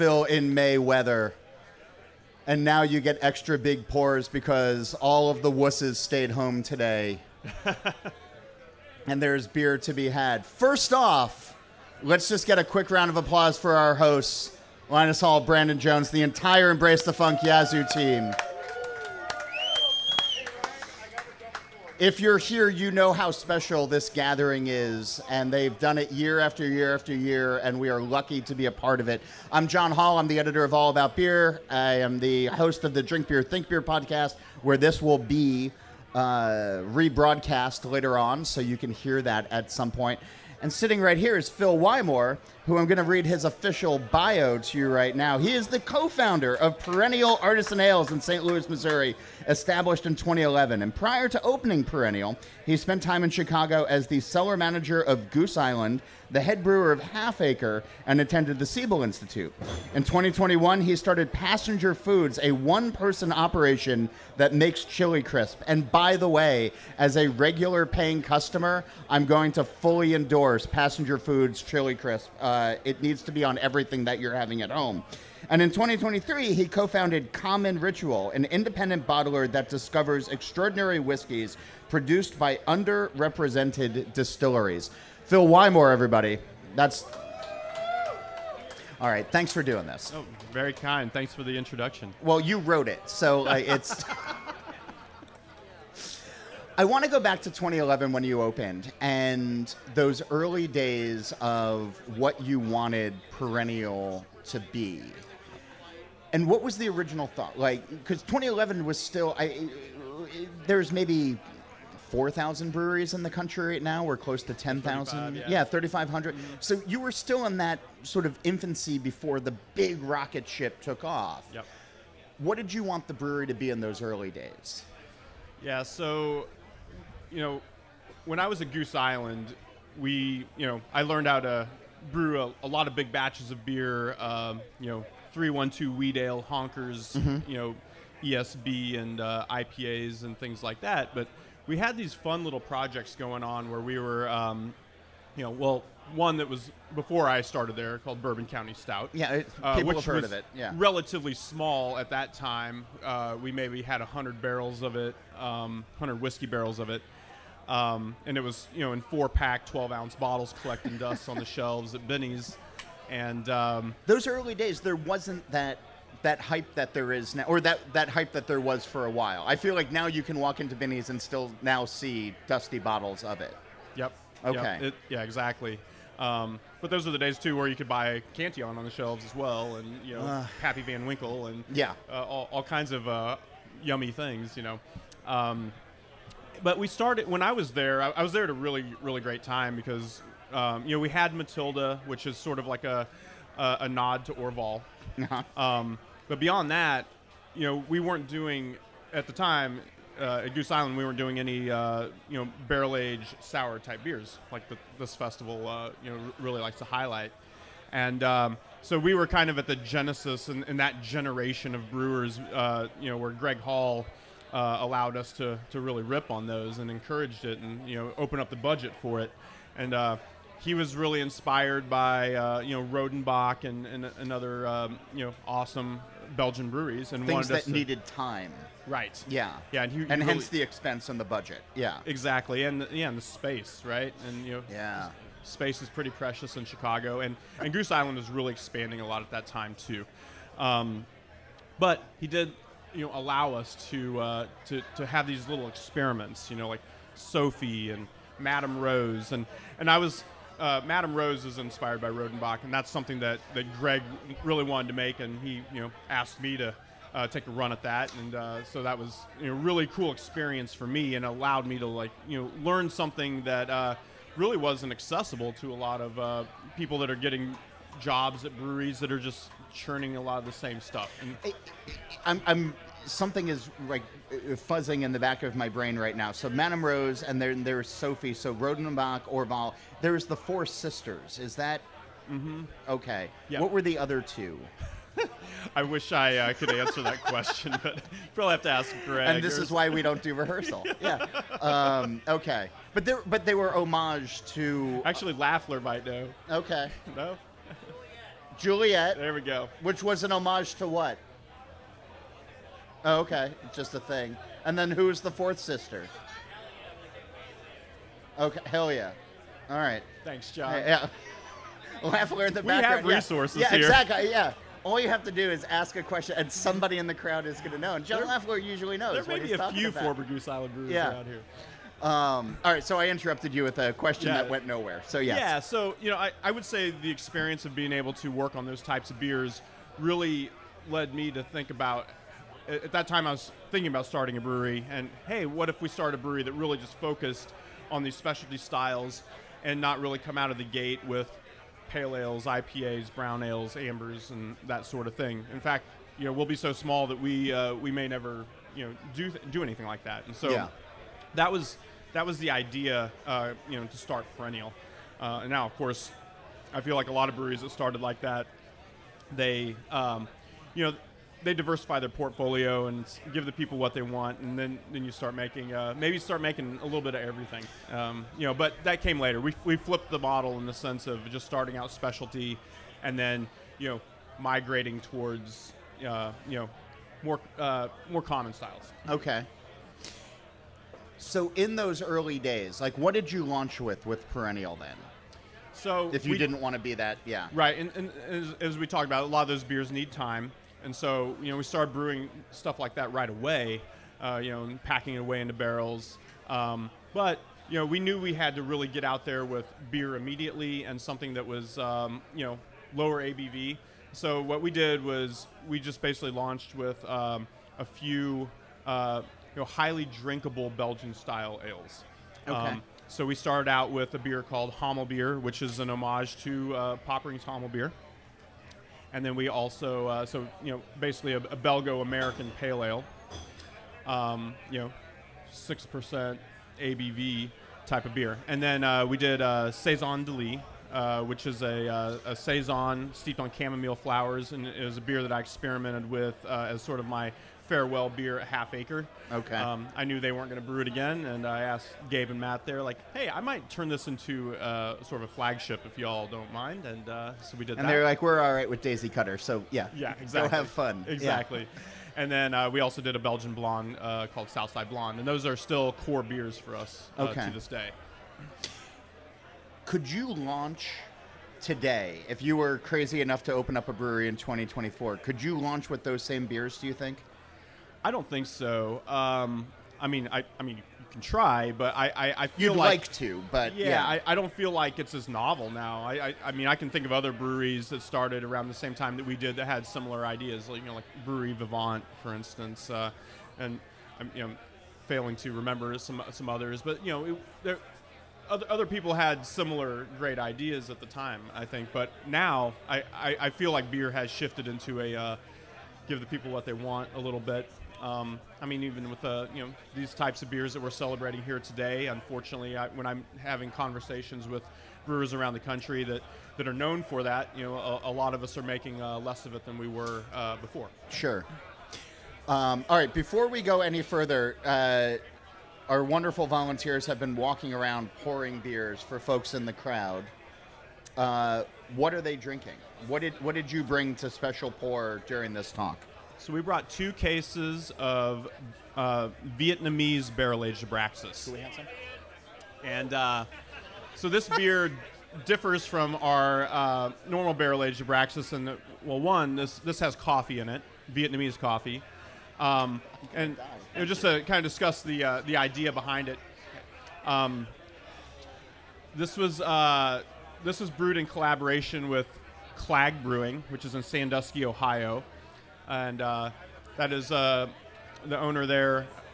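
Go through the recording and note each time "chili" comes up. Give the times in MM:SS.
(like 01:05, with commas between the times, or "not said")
01:04, 01:11.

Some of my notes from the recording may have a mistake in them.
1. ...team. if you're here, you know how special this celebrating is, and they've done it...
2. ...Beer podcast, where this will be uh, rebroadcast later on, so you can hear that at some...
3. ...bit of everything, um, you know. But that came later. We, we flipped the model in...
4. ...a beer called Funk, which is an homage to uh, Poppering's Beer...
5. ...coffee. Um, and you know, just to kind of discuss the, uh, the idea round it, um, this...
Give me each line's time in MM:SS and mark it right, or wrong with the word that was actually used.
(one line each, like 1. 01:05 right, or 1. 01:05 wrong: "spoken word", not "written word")
1. 00:17 wrong: "gathering", not "celebrating"
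2. 00:33 right
3. 06:06 right
4. 06:54 wrong: "Beer", not "Funk"
5. 09:01 wrong: "behind", not "round".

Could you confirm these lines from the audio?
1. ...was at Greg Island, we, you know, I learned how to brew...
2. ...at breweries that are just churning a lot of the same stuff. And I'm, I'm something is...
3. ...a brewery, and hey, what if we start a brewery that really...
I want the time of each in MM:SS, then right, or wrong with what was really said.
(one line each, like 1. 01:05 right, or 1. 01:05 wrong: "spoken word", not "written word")
1. 02:08 wrong: "Goose", not "Greg"
2. 04:28 right
3. 05:34 right.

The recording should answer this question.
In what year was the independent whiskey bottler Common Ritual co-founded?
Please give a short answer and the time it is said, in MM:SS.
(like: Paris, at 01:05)
2023, at 01:15.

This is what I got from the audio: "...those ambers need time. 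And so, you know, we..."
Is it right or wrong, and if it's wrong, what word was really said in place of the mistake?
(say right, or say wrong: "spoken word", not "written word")
wrong: "beers", not "ambers".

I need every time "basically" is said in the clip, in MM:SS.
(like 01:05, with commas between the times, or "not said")
06:45, 07:00.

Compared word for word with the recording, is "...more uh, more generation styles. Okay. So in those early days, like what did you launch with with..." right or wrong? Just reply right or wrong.
wrong.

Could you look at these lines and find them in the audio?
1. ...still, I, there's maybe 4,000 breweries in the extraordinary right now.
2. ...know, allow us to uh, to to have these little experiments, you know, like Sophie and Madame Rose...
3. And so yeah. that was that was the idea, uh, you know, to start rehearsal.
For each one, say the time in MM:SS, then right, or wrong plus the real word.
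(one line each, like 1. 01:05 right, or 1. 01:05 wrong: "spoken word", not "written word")
1. 01:48 wrong: "country", not "extraordinary"
2. 04:03 right
3. 05:50 wrong: "perennial", not "rehearsal".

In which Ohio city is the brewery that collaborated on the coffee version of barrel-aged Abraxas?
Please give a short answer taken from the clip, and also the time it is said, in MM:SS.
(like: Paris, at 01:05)
Sandusky, at 09:14.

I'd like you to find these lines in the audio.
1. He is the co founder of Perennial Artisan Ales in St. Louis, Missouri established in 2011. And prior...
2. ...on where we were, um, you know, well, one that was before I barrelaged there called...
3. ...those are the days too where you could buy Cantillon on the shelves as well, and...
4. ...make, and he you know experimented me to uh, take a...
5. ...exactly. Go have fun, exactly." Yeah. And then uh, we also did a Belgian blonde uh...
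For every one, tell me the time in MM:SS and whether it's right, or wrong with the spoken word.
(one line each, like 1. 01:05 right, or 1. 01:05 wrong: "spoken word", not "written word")
1. 00:45 right
2. 02:23 wrong: "started", not "barrelaged"
3. 02:56 right
4. 04:14 wrong: "asked", not "experimented"
5. 07:30 right.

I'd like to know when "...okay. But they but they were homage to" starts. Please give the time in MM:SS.
04:52.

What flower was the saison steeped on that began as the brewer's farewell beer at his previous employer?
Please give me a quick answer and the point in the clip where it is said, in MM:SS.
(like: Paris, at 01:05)
chamomile, at 07:13.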